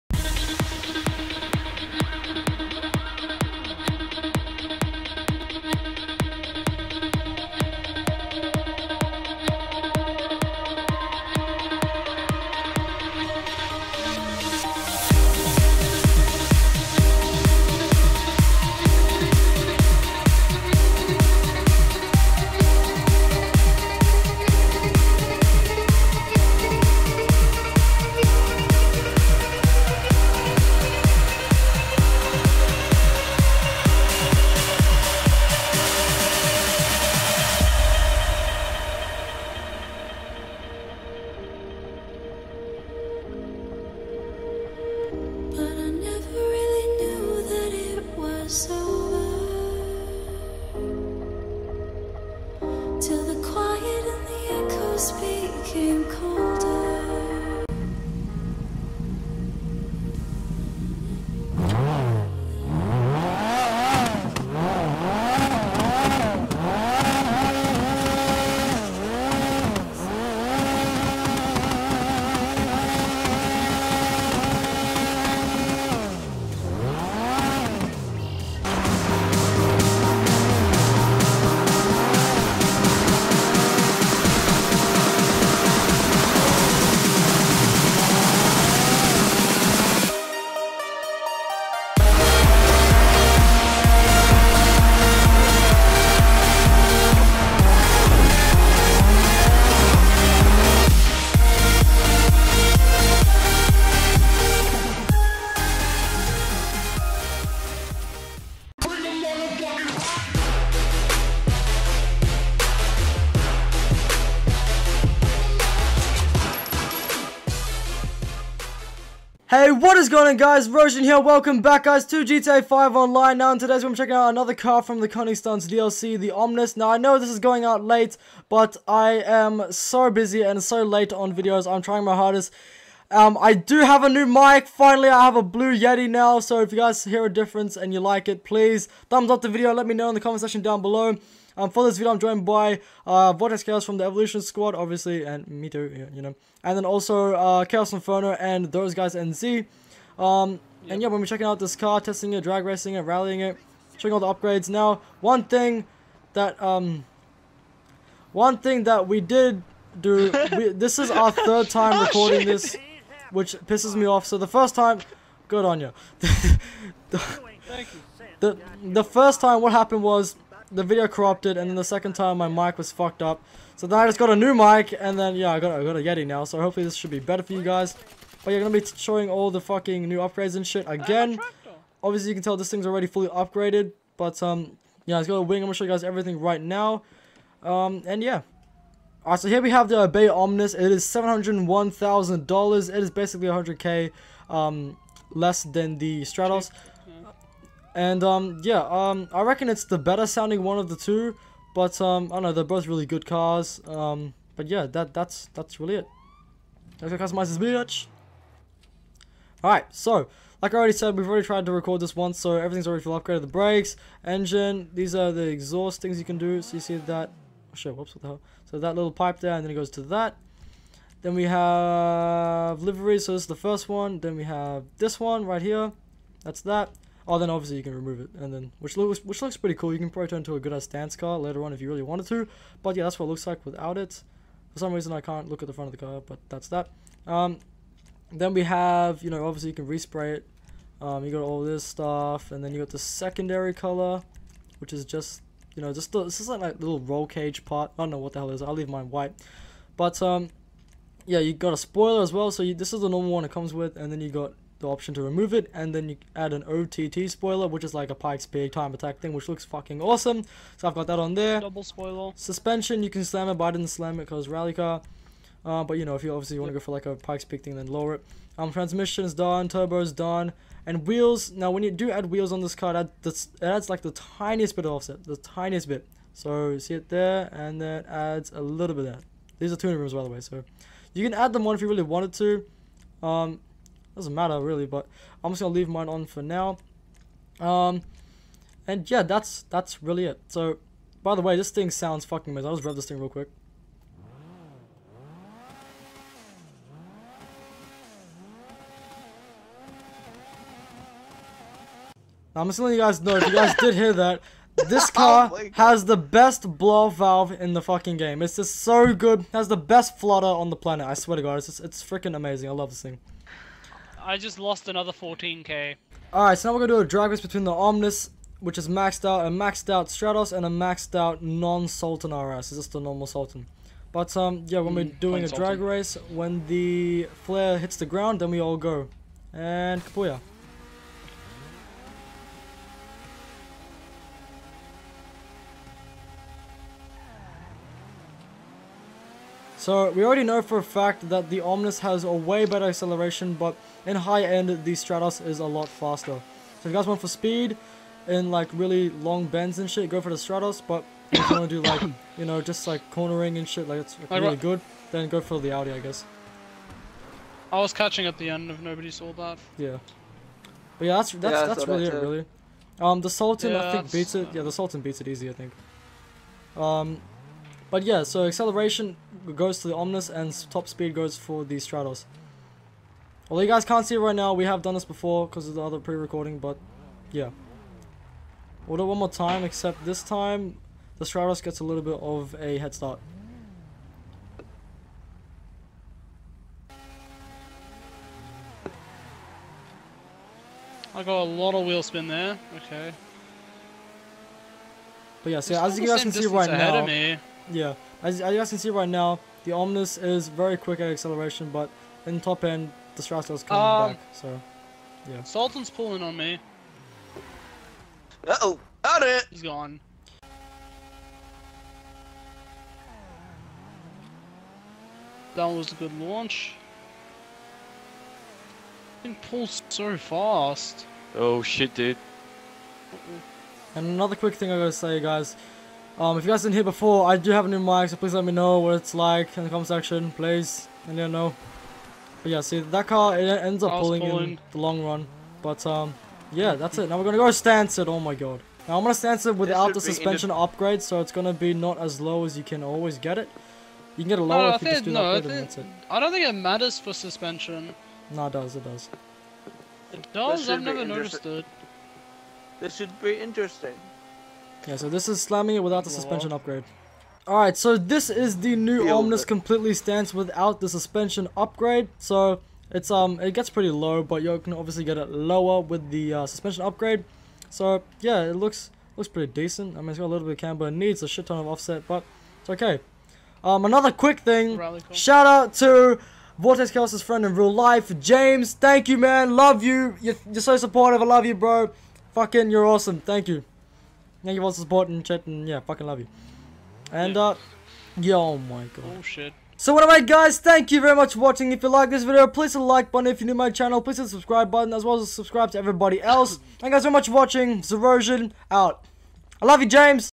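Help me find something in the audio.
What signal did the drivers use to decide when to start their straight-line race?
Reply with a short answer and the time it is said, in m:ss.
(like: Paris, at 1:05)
flare hits the ground, at 5:26.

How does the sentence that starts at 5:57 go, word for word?
I was catching at the end if nobody saw that.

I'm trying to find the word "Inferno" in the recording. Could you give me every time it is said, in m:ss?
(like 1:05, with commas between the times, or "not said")
2:27.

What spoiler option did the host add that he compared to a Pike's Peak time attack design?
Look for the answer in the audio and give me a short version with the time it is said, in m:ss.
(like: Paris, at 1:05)
OTT spoiler, at 4:16.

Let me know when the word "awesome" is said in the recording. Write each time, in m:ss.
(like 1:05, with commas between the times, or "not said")
4:20, 8:02.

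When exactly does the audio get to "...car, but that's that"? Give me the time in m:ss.
3:56.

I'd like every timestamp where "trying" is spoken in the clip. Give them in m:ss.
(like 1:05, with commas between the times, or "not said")
2:11.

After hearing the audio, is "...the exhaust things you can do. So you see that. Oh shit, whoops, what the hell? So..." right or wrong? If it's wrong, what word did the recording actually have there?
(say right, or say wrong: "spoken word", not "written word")
right.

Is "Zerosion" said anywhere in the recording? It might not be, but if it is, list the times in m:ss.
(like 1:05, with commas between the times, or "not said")
2:00, 8:17.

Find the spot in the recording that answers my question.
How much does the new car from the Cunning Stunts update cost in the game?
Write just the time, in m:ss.
3:11.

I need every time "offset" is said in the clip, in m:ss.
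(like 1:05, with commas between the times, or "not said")
4:34, 7:51.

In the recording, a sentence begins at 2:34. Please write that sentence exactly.
Now, one thing that, um, one thing that we did do, we, this is our third time recording this.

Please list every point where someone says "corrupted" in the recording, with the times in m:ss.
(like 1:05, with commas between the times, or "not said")
2:51.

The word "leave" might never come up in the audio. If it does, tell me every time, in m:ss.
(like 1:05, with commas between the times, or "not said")
4:08, 4:45.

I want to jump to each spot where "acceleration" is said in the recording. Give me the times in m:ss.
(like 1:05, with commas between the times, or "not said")
5:42, 6:08, 6:41.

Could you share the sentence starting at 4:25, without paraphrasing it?
Uh, but you know, if you obviously want to go for like a Pikes Peak thing, then lower it.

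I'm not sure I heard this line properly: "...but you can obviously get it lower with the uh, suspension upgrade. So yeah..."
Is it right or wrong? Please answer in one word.
right.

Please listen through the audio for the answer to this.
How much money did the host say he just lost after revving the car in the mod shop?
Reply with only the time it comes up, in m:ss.
5:15.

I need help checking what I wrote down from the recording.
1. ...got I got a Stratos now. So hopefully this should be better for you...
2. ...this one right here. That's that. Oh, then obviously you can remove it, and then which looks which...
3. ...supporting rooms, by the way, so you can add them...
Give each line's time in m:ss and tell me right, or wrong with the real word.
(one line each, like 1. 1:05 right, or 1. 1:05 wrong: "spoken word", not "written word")
1. 2:55 wrong: "Yeti", not "Stratos"
2. 3:44 right
3. 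4:39 wrong: "tuning", not "supporting".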